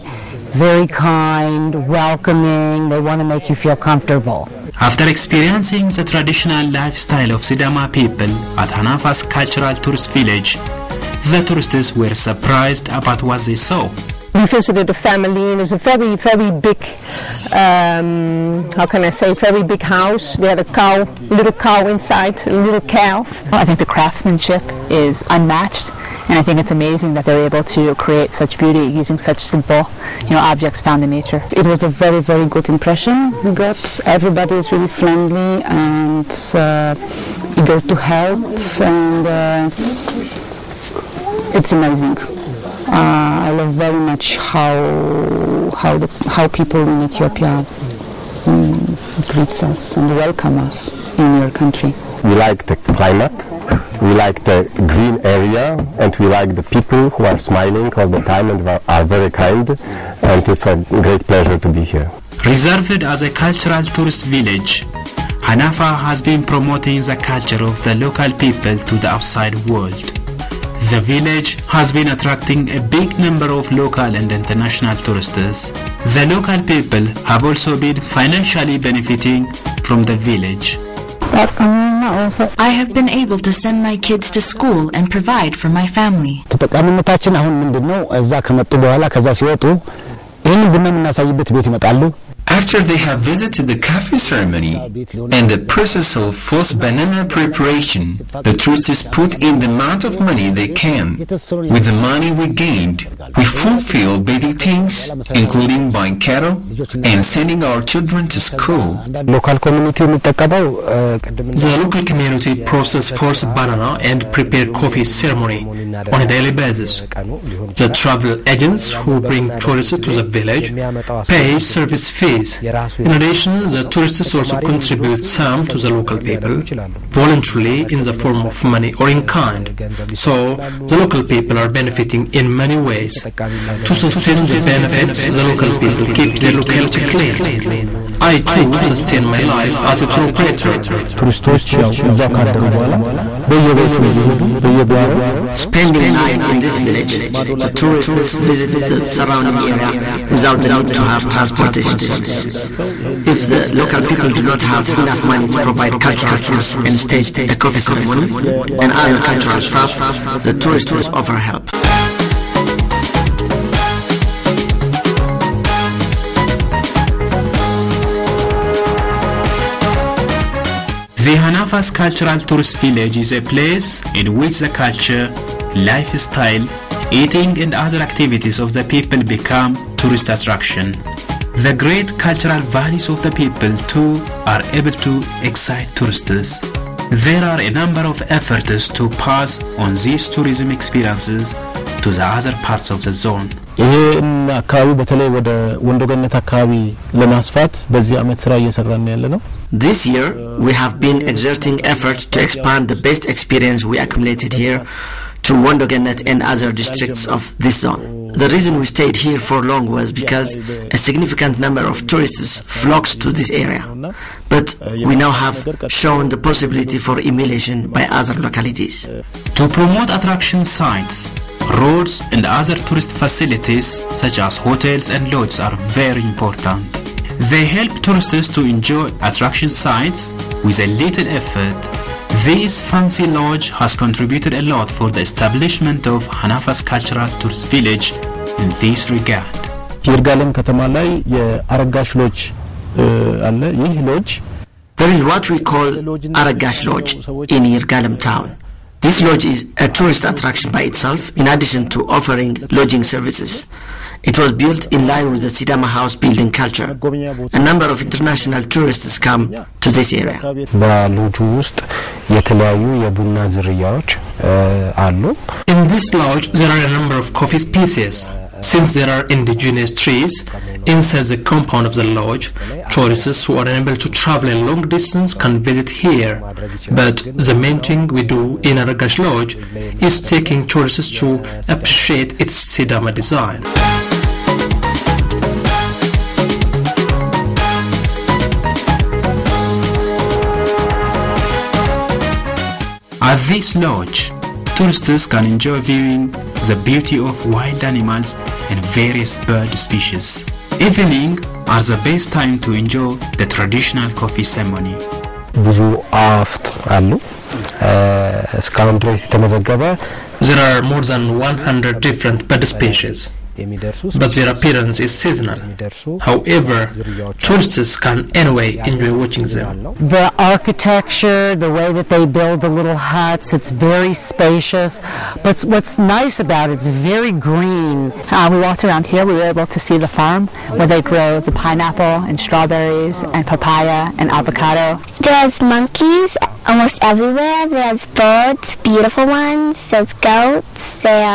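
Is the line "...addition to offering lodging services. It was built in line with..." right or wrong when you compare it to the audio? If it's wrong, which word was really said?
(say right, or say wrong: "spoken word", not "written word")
right.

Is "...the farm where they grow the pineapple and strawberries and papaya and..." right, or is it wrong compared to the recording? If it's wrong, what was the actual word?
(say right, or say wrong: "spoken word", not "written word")
right.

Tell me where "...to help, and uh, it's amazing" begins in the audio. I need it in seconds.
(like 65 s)
37 s.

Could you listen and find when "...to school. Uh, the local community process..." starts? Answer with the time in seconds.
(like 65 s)
108 s.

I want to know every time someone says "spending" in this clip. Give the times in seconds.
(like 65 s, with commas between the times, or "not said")
145 s.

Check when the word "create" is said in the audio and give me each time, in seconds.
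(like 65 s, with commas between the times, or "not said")
27 s.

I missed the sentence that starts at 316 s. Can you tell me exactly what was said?
However, tourists can anyway enjoy watching them.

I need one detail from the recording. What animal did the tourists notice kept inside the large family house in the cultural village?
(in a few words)
Little calf.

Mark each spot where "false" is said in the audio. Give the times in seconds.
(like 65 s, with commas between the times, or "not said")
96 s, 113 s.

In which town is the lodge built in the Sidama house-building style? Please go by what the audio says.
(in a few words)
Yirgalem.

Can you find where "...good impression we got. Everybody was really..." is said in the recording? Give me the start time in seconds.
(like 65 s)
32 s.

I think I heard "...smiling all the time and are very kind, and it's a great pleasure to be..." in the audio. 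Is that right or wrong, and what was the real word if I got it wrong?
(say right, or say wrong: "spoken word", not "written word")
right.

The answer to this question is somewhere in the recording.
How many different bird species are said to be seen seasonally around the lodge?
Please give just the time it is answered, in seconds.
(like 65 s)
310 s.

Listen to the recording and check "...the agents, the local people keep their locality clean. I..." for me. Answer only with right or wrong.
wrong.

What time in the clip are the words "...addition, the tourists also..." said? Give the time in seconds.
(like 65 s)
123 s.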